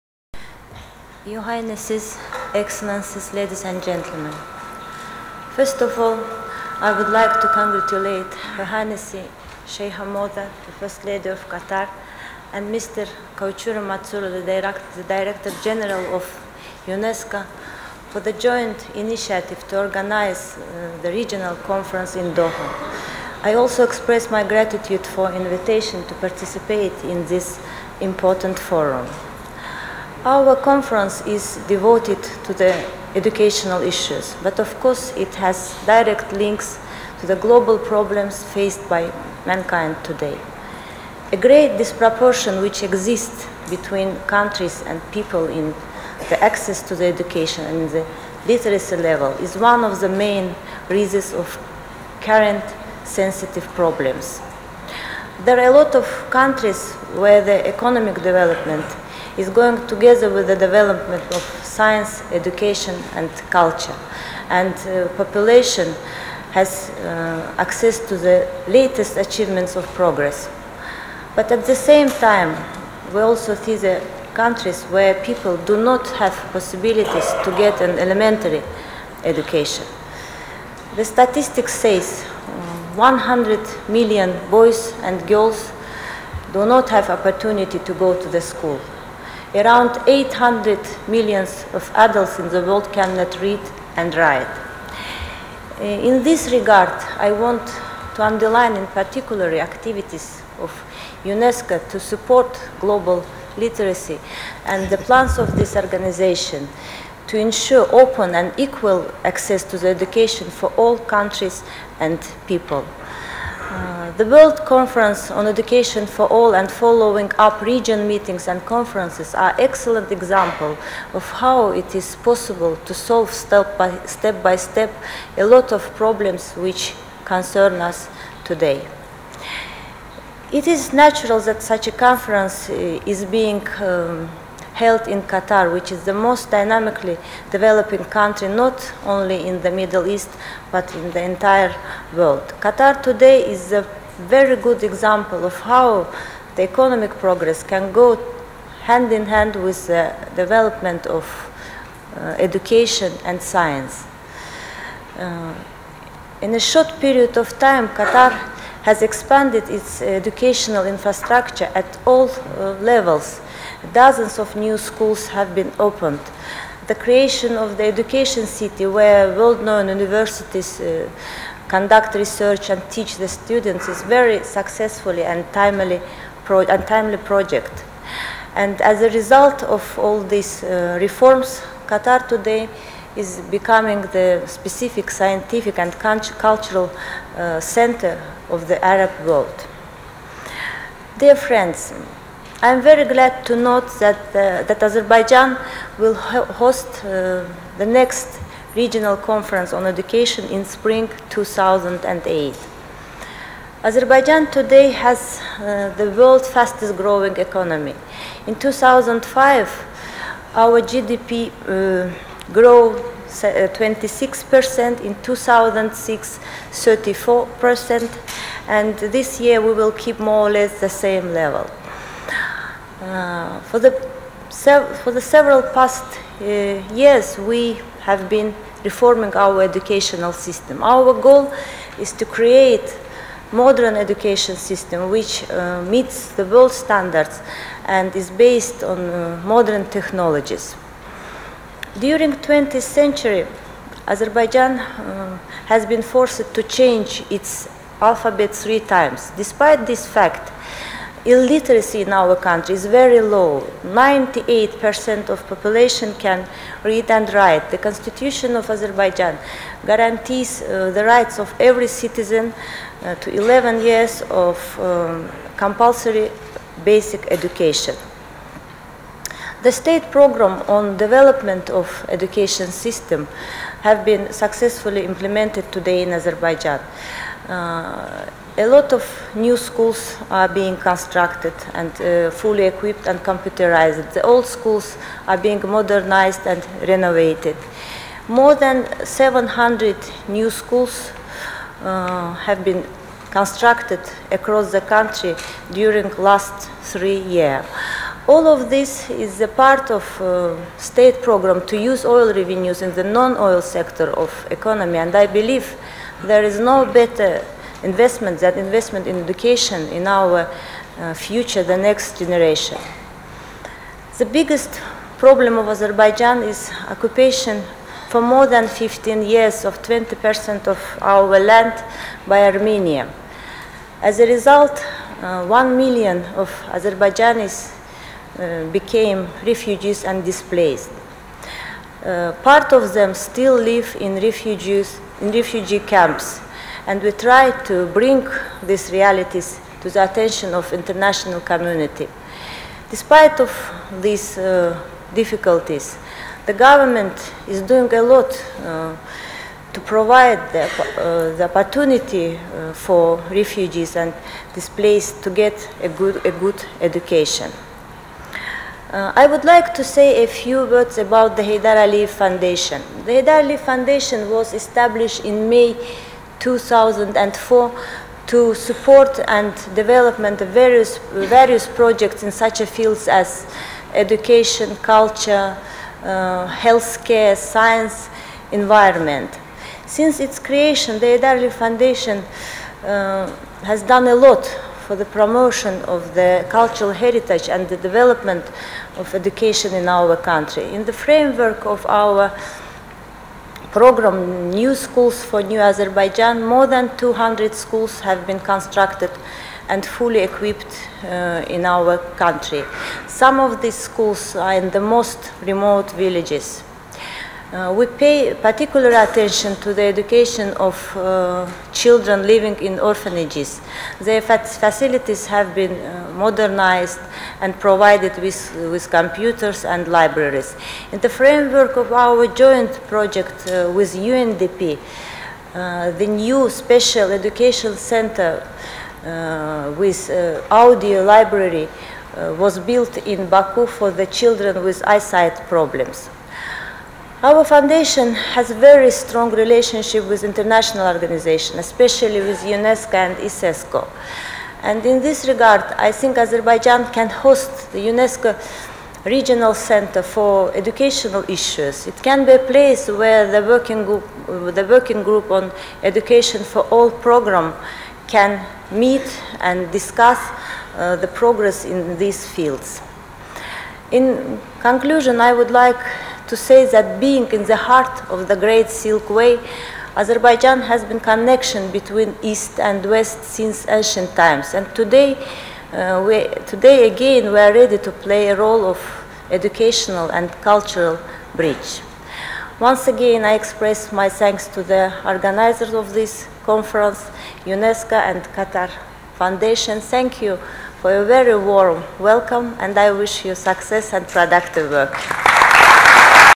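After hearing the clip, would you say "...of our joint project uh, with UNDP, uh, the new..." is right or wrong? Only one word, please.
right.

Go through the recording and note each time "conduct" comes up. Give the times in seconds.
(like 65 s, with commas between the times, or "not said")
171 s.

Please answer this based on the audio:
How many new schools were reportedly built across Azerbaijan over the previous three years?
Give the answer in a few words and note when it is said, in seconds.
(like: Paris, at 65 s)
700, at 289 s.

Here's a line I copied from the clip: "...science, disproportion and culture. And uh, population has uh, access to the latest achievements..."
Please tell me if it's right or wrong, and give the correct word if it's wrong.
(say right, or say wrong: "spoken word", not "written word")
wrong: "education", not "disproportion".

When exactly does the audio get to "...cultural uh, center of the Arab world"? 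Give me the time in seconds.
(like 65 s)
185 s.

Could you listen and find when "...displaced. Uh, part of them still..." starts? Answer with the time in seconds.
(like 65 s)
330 s.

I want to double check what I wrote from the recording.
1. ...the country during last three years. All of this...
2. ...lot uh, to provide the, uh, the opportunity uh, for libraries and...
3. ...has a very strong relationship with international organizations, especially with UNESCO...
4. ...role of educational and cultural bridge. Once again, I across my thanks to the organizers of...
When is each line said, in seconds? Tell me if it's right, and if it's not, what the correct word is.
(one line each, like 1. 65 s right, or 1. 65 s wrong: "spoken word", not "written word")
1. 294 s right
2. 348 s wrong: "refugees", not "libraries"
3. 438 s right
4. 478 s wrong: "express", not "across".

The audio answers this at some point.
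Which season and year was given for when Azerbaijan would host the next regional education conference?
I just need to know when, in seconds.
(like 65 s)
200 s.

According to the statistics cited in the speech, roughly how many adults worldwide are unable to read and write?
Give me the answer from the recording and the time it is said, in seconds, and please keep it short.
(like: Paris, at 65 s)
800 million, at 90 s.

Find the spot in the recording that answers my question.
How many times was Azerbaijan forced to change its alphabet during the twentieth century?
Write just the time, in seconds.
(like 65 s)
248 s.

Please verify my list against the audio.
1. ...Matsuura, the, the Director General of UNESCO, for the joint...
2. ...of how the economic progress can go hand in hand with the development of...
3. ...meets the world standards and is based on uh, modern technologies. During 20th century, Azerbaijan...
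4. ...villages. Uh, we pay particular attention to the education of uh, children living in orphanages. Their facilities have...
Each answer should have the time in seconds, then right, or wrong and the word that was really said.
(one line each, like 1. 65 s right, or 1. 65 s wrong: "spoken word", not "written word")
1. 13 s right
2. 145 s right
3. 235 s right
4. 405 s right.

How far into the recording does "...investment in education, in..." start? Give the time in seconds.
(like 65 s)
308 s.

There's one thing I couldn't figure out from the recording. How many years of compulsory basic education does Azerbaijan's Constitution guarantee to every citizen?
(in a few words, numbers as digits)
11 years.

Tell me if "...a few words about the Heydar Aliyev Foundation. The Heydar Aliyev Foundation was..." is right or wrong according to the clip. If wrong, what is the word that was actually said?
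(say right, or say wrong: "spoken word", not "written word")
right.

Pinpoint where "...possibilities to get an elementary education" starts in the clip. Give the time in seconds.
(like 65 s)
76 s.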